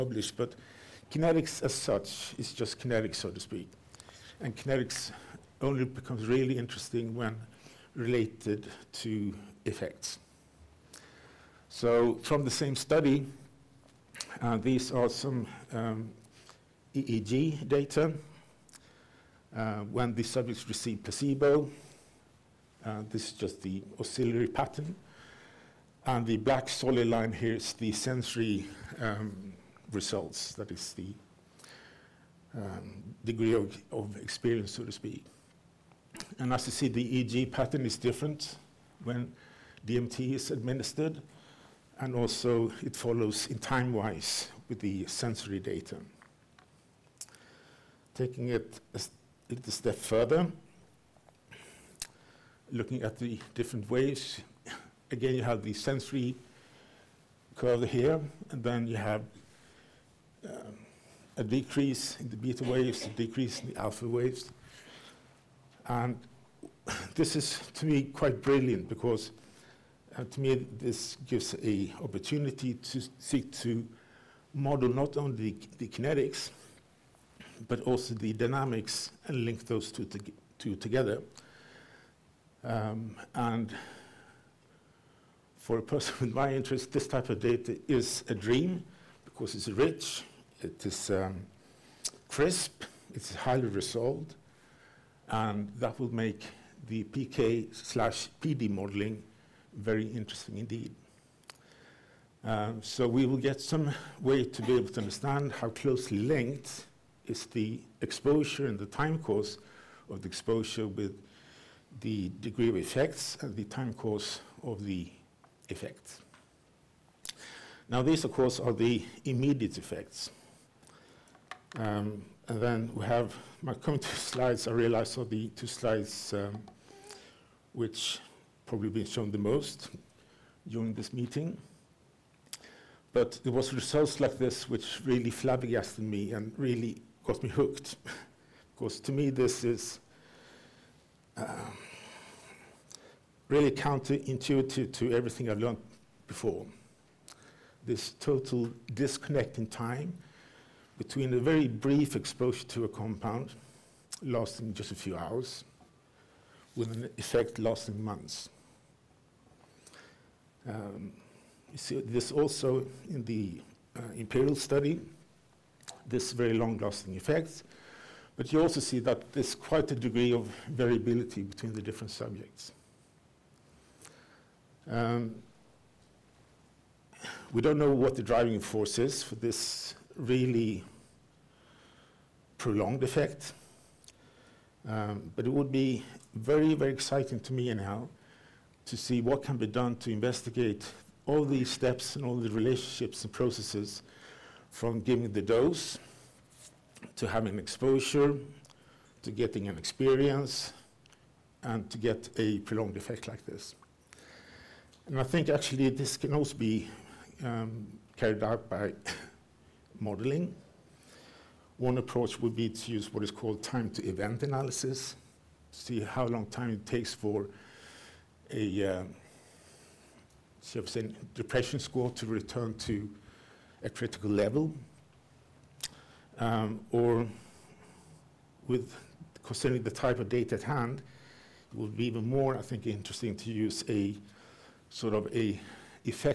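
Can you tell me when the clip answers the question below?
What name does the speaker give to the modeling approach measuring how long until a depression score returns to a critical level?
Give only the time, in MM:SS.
03:33.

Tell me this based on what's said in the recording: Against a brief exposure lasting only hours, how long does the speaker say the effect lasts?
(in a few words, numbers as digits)
months.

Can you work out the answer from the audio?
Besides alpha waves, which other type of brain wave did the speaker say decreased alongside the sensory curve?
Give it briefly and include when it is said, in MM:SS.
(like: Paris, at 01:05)
beta waves, at 01:02.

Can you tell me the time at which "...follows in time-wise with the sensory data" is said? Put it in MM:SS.
00:42.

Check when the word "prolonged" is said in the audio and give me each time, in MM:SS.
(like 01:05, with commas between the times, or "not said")
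03:02, 03:22.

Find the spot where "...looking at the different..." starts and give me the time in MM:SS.
00:52.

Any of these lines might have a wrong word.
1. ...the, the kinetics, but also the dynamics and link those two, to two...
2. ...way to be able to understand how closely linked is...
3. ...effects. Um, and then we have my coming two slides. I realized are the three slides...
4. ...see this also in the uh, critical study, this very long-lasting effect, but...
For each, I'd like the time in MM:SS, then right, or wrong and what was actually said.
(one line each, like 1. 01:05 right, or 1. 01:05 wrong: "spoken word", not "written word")
1. 01:15 right
2. 01:44 right
3. 01:59 wrong: "two", not "three"
4. 02:41 wrong: "imperial", not "critical".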